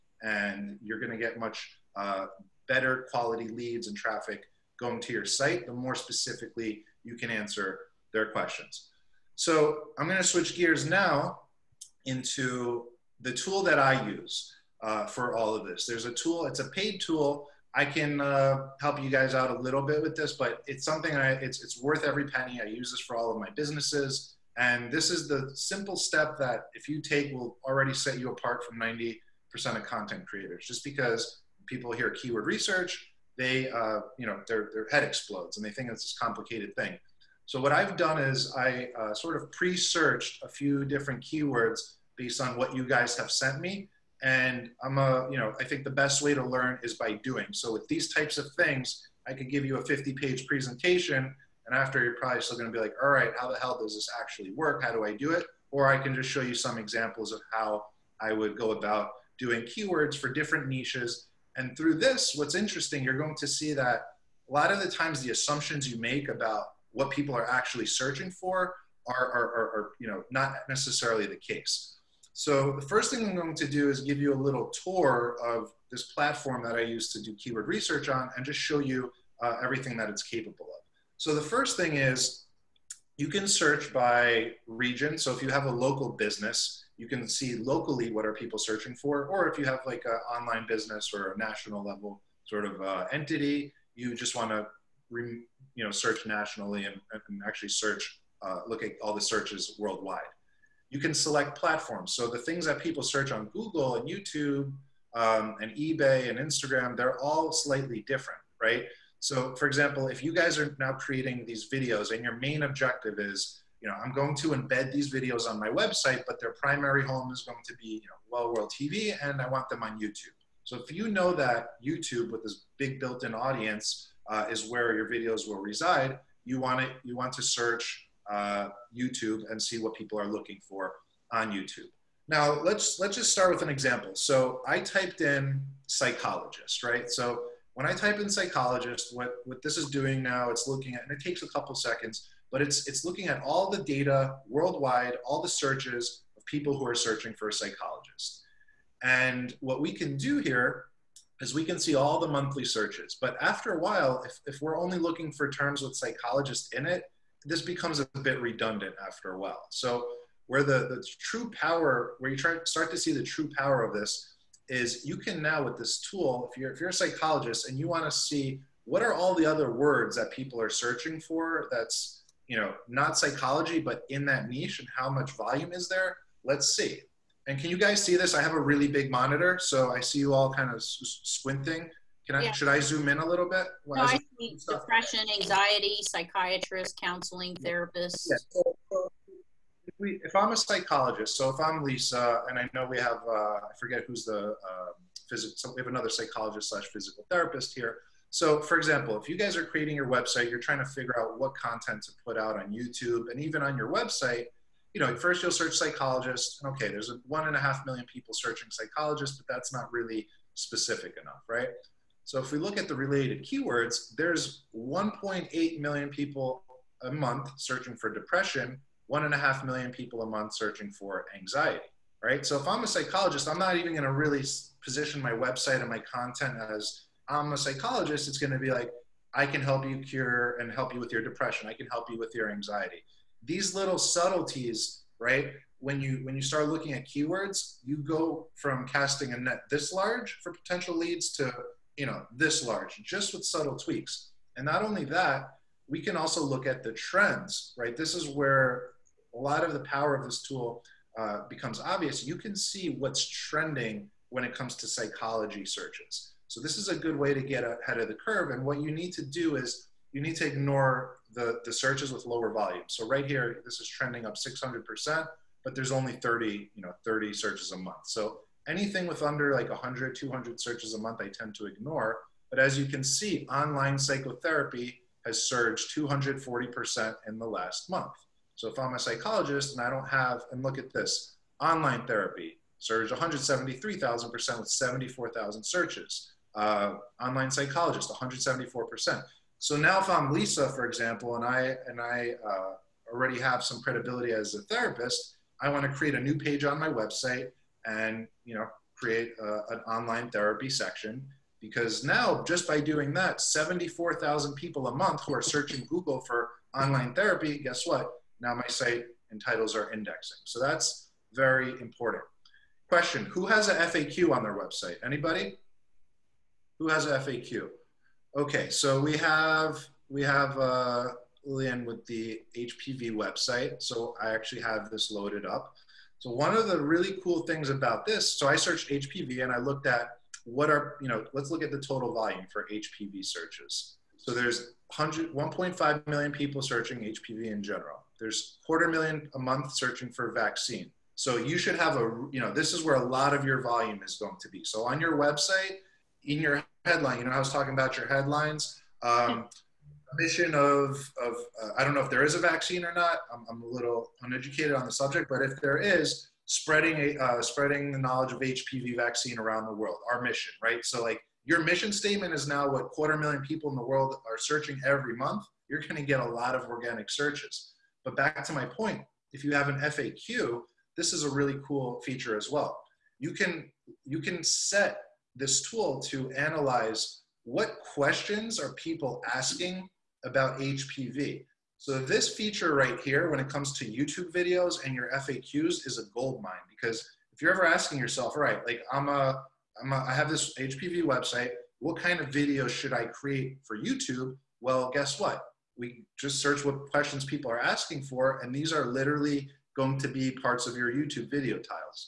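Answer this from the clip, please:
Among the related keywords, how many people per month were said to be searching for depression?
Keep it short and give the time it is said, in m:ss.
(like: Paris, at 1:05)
1.8 million, at 3:34.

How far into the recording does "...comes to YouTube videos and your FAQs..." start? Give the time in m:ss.
6:23.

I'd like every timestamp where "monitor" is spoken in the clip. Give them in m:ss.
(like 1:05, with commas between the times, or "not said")
2:59.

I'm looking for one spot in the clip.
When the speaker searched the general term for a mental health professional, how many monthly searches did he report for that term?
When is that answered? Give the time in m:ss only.
3:27.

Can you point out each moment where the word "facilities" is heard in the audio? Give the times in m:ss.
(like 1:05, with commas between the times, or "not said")
not said.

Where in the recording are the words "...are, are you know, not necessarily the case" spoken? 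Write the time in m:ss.
1:09.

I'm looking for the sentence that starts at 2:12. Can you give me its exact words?
Now let's let's just start with an example.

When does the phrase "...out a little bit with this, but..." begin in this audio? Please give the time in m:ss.
0:19.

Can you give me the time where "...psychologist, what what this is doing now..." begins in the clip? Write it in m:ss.
2:18.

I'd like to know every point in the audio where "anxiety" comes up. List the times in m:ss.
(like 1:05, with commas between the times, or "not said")
3:05, 3:41, 3:52.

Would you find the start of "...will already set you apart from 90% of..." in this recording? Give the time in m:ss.
0:27.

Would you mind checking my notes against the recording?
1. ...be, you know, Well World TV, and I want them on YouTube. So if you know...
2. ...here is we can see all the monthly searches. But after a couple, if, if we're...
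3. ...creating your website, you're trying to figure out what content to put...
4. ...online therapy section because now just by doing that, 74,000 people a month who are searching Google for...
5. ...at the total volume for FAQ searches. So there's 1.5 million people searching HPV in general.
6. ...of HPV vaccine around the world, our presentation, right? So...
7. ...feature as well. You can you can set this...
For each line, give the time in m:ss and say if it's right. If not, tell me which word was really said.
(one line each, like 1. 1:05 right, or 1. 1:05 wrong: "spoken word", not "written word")
1. 1:57 right
2. 2:30 wrong: "while", not "couple"
3. 3:19 right
4. 4:59 right
5. 5:31 wrong: "HPV", not "FAQ"
6. 5:58 wrong: "mission", not "presentation"
7. 6:12 right.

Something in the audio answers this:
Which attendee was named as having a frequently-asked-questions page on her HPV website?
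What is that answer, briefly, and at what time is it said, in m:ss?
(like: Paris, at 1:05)
Lillian, at 5:21.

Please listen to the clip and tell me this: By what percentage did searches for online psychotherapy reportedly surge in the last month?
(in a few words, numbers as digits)
240%.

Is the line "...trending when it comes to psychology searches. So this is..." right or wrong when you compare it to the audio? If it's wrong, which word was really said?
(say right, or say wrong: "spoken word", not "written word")
right.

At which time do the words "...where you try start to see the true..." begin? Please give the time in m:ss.
2:42.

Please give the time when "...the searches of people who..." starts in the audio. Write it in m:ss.
2:25.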